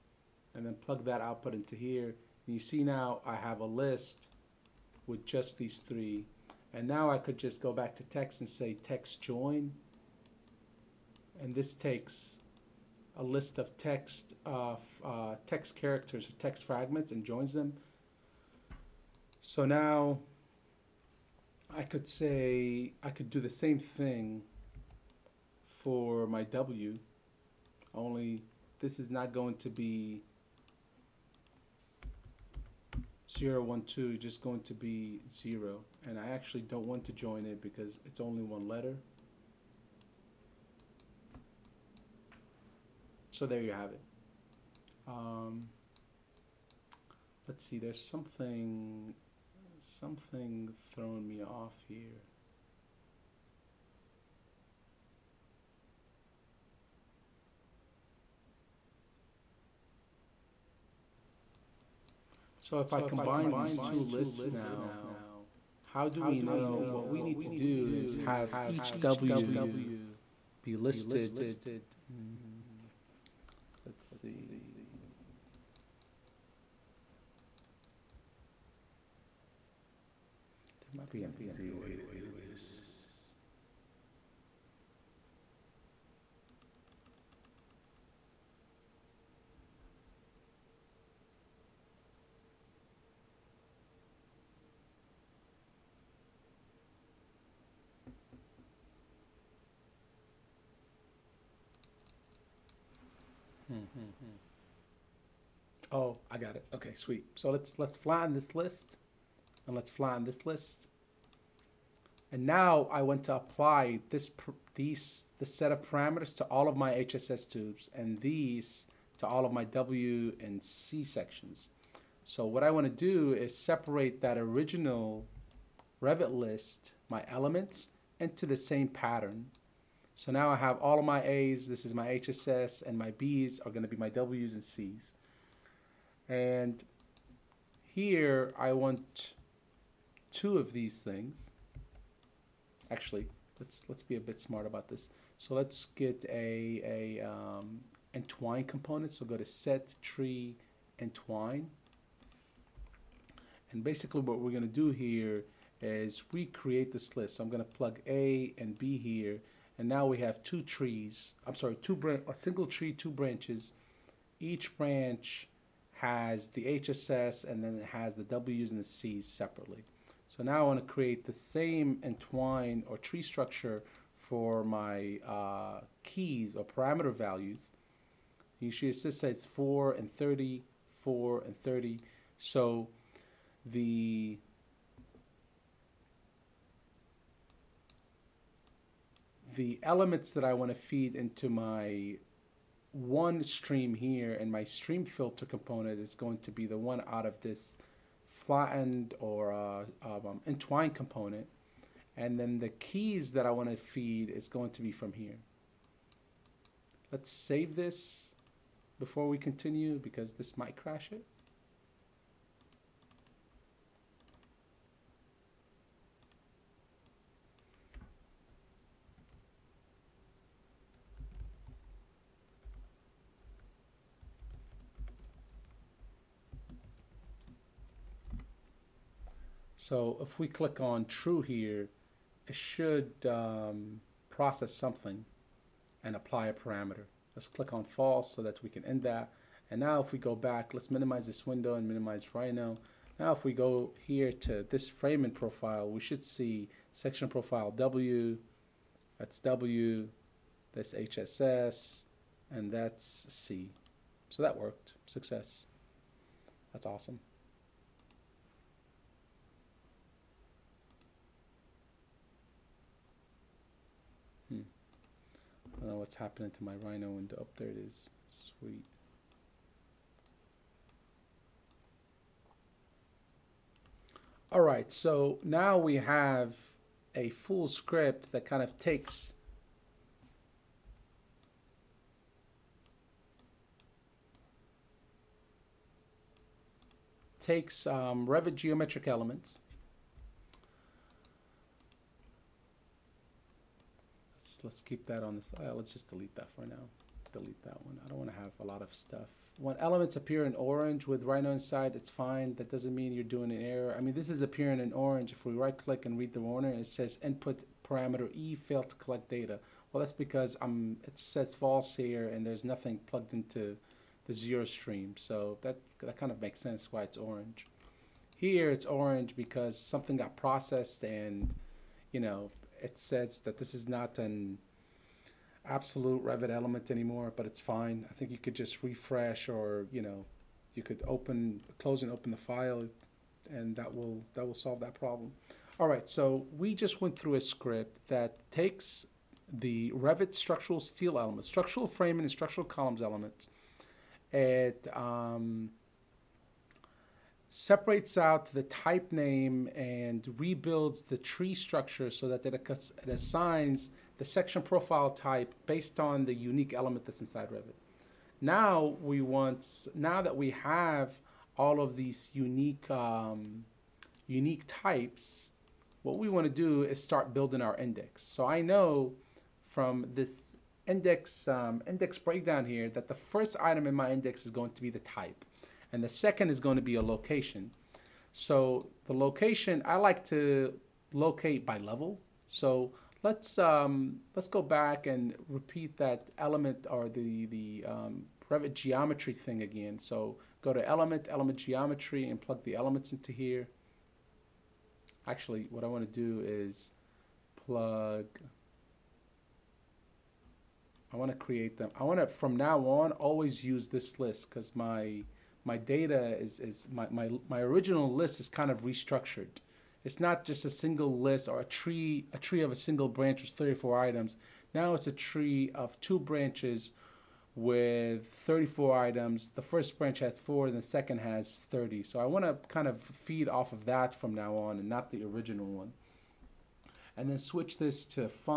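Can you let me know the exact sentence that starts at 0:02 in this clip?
And you see now I have a list with just these three.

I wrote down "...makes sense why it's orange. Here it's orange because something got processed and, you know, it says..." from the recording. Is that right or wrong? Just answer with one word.
right.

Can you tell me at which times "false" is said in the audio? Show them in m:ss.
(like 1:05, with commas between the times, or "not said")
3:57, 5:11.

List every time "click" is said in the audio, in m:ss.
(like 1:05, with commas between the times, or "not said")
3:50, 3:57, 5:05.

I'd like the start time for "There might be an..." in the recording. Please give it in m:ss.
1:20.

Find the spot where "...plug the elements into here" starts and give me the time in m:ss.
6:32.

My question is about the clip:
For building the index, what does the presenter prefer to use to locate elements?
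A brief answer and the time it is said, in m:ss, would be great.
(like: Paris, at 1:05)
Level, at 6:21.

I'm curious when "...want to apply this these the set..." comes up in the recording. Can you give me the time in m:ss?
1:53.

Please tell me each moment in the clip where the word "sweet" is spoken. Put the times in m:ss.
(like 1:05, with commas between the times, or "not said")
1:46, 4:28.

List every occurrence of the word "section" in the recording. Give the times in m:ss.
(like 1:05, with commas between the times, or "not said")
2:01, 4:06, 5:54.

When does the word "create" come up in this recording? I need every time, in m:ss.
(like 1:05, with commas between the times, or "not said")
2:36, 2:50, 6:41.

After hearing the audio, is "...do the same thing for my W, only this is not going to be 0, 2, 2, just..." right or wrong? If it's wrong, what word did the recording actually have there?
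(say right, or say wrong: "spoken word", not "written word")
wrong: "1", not "2".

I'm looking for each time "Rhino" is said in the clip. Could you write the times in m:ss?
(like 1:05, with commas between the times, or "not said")
4:02, 4:26, 5:01.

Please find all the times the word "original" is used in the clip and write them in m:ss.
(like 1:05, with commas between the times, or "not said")
2:04, 6:47, 7:05.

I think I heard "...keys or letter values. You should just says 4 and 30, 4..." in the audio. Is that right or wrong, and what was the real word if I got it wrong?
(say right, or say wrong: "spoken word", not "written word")
wrong: "parameter", not "letter".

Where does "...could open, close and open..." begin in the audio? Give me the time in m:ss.
5:30.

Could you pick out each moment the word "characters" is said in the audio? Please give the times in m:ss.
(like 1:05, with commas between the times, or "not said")
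0:15.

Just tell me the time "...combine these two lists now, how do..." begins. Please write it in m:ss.
1:02.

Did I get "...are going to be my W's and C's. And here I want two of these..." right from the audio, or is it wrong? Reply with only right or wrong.
right.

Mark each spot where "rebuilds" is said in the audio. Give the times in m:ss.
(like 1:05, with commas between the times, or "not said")
5:50.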